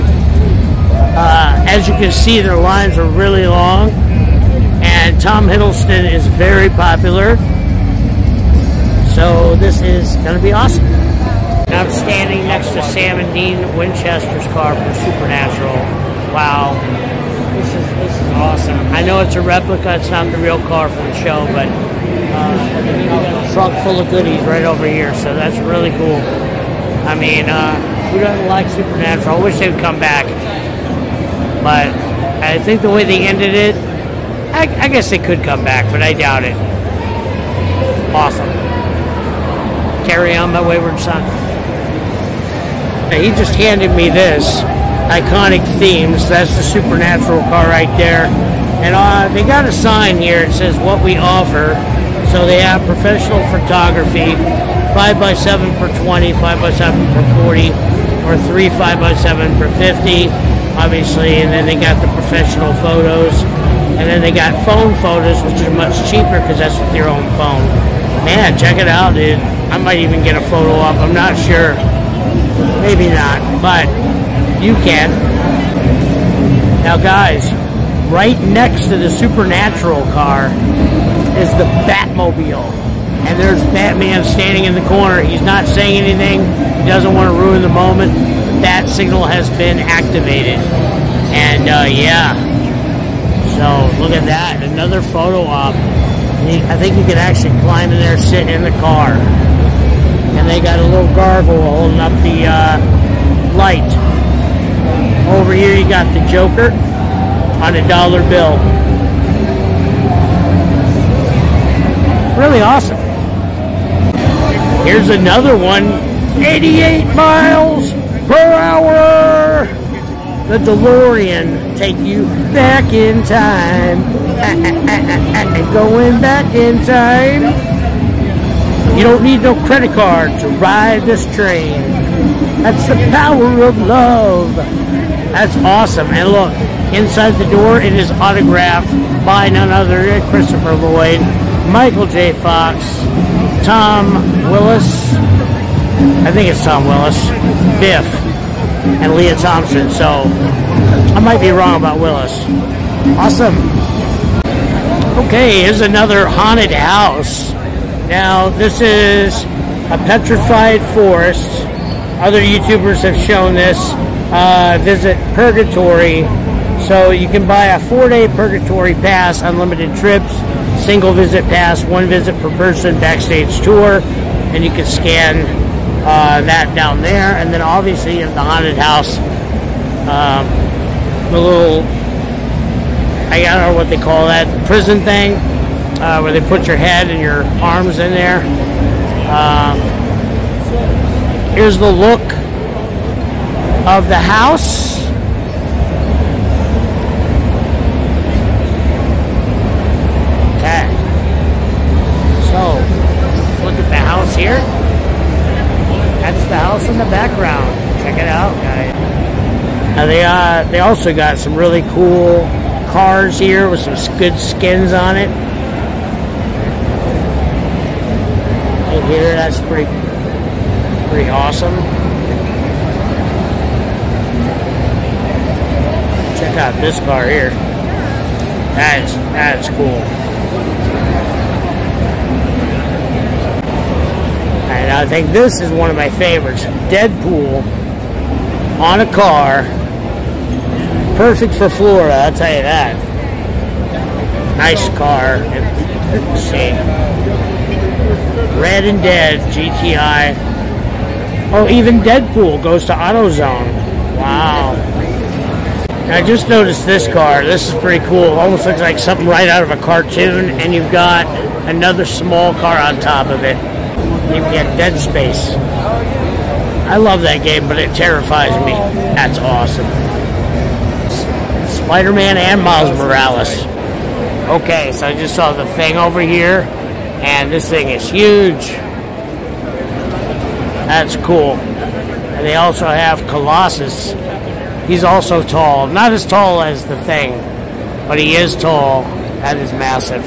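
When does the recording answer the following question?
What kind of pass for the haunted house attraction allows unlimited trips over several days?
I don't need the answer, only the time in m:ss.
2:47.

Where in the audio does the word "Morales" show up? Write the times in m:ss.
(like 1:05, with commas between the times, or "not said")
4:32.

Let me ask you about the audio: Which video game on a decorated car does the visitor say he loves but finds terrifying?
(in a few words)
Dead Space.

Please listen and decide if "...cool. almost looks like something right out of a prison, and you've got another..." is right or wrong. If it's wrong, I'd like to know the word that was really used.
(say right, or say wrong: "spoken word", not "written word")
wrong: "cartoon", not "prison".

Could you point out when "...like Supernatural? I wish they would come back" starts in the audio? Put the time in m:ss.
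0:28.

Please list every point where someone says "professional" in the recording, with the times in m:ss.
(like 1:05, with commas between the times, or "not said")
0:52, 1:02.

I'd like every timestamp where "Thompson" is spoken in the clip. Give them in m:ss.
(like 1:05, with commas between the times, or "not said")
2:29.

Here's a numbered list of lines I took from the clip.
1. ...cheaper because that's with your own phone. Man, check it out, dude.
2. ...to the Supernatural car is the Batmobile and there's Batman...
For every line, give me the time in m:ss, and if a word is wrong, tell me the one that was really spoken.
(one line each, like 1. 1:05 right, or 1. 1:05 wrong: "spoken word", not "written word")
1. 1:06 right
2. 1:18 right.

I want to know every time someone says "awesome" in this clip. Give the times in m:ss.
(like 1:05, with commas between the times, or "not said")
0:10, 0:18, 0:38, 1:52, 2:15, 2:33, 3:41, 4:29.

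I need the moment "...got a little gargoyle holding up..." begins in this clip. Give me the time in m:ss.
1:40.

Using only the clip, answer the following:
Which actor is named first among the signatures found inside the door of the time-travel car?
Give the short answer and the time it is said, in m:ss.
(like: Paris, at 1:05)
Christopher Lloyd, at 2:20.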